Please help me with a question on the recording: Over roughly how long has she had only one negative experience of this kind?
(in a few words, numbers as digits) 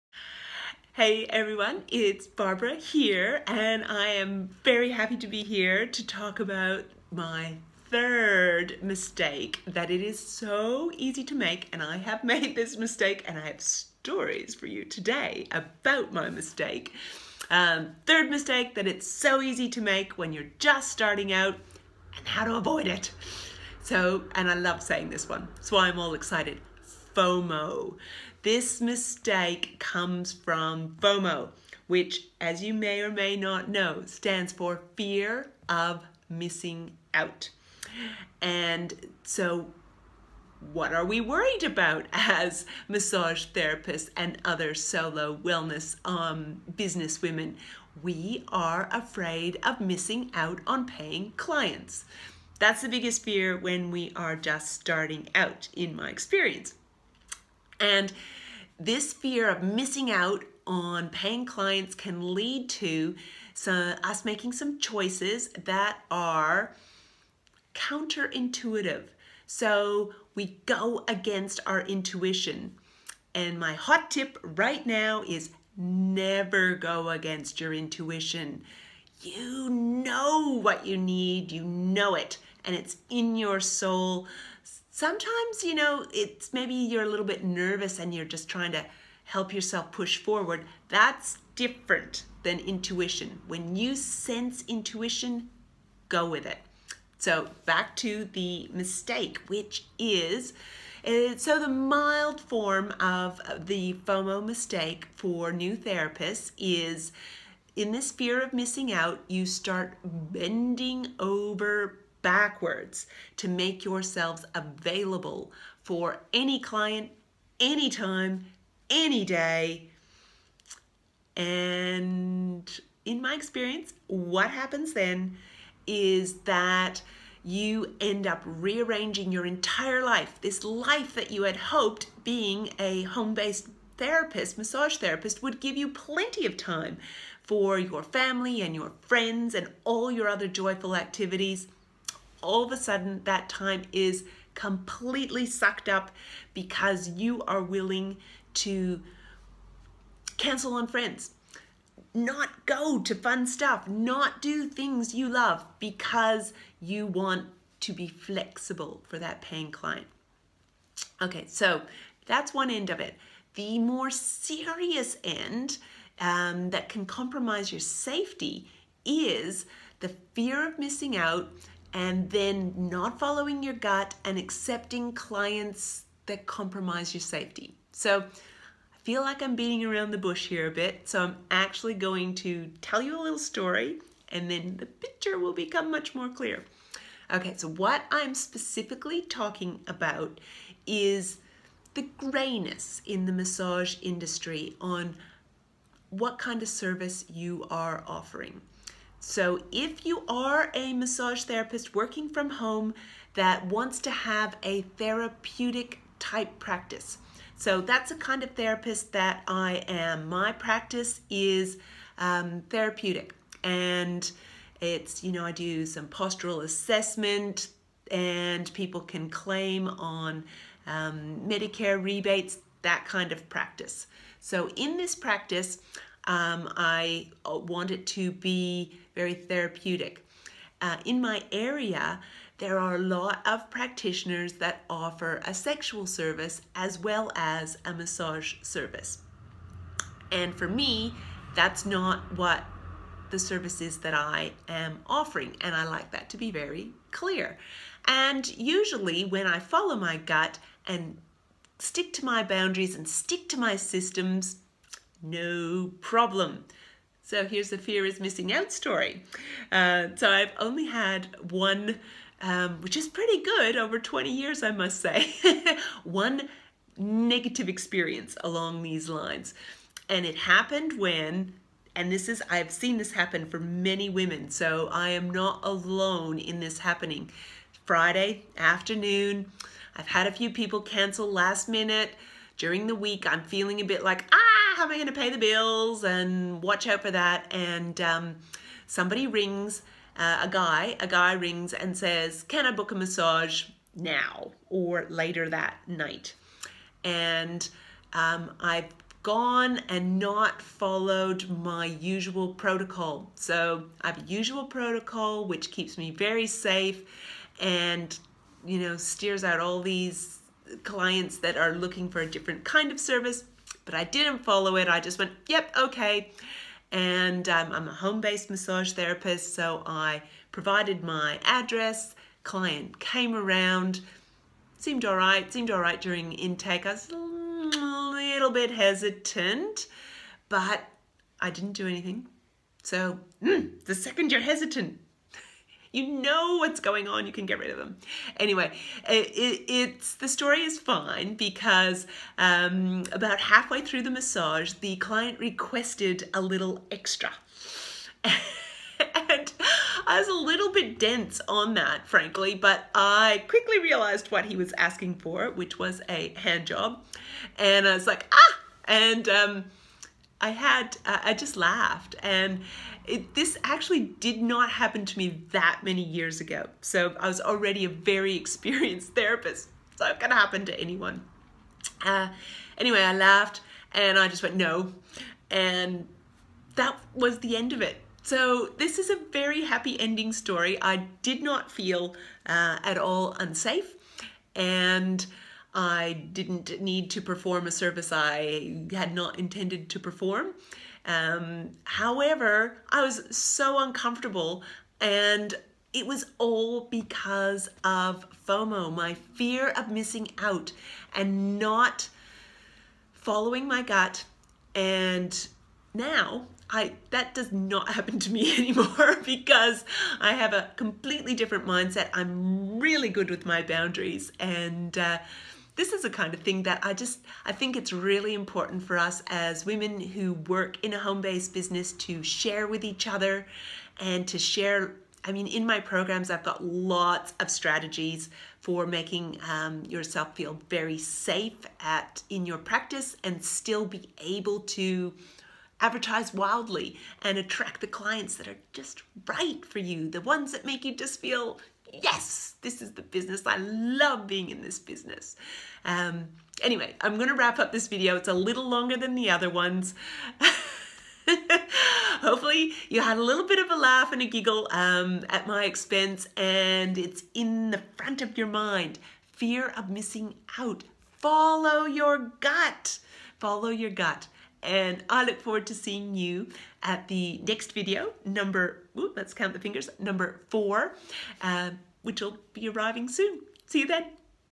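20 years.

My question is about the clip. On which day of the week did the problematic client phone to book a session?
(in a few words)
Friday.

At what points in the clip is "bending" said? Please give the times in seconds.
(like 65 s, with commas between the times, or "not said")
110 s.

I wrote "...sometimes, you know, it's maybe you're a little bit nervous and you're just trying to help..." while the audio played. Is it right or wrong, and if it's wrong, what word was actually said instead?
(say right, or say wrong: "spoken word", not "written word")
right.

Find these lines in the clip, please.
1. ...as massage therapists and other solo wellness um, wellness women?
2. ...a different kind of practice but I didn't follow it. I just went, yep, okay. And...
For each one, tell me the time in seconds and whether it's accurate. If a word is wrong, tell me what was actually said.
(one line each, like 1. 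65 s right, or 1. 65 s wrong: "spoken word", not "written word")
1. 42 s wrong: "business", not "wellness"
2. 312 s wrong: "service", not "practice".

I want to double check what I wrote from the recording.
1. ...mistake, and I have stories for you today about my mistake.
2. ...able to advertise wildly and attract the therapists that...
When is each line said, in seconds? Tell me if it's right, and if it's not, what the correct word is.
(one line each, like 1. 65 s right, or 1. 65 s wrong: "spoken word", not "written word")
1. 12 s right
2. 434 s wrong: "clients", not "therapists".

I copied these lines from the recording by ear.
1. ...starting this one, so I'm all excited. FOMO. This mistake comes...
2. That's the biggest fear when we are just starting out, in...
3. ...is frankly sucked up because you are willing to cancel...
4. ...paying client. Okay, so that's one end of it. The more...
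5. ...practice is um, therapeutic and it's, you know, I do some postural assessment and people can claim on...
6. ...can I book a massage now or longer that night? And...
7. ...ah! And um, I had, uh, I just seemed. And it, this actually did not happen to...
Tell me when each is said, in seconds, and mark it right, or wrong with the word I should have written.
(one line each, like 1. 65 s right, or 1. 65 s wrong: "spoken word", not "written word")
1. 24 s wrong: "saying", not "starting"
2. 52 s right
3. 143 s wrong: "completely", not "frankly"
4. 159 s right
5. 210 s right
6. 292 s wrong: "later", not "longer"
7. 358 s wrong: "laughed", not "seemed".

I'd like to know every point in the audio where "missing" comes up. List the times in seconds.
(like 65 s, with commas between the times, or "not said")
36 s, 49 s, 59 s, 108 s, 170 s, 258 s, 399 s, 459 s.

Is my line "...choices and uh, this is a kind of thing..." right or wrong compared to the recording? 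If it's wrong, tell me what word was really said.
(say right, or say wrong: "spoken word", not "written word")
wrong: "boundaries", not "choices".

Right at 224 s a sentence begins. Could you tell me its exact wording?
So in this practice, um, I uh, want it to be very therapeutic.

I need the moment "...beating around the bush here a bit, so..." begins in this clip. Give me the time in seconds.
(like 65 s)
179 s.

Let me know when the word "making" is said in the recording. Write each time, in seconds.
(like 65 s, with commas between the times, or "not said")
64 s, 428 s.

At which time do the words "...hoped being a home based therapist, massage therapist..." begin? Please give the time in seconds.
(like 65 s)
131 s.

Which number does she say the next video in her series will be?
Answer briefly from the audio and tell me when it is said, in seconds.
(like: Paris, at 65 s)
4, at 470 s.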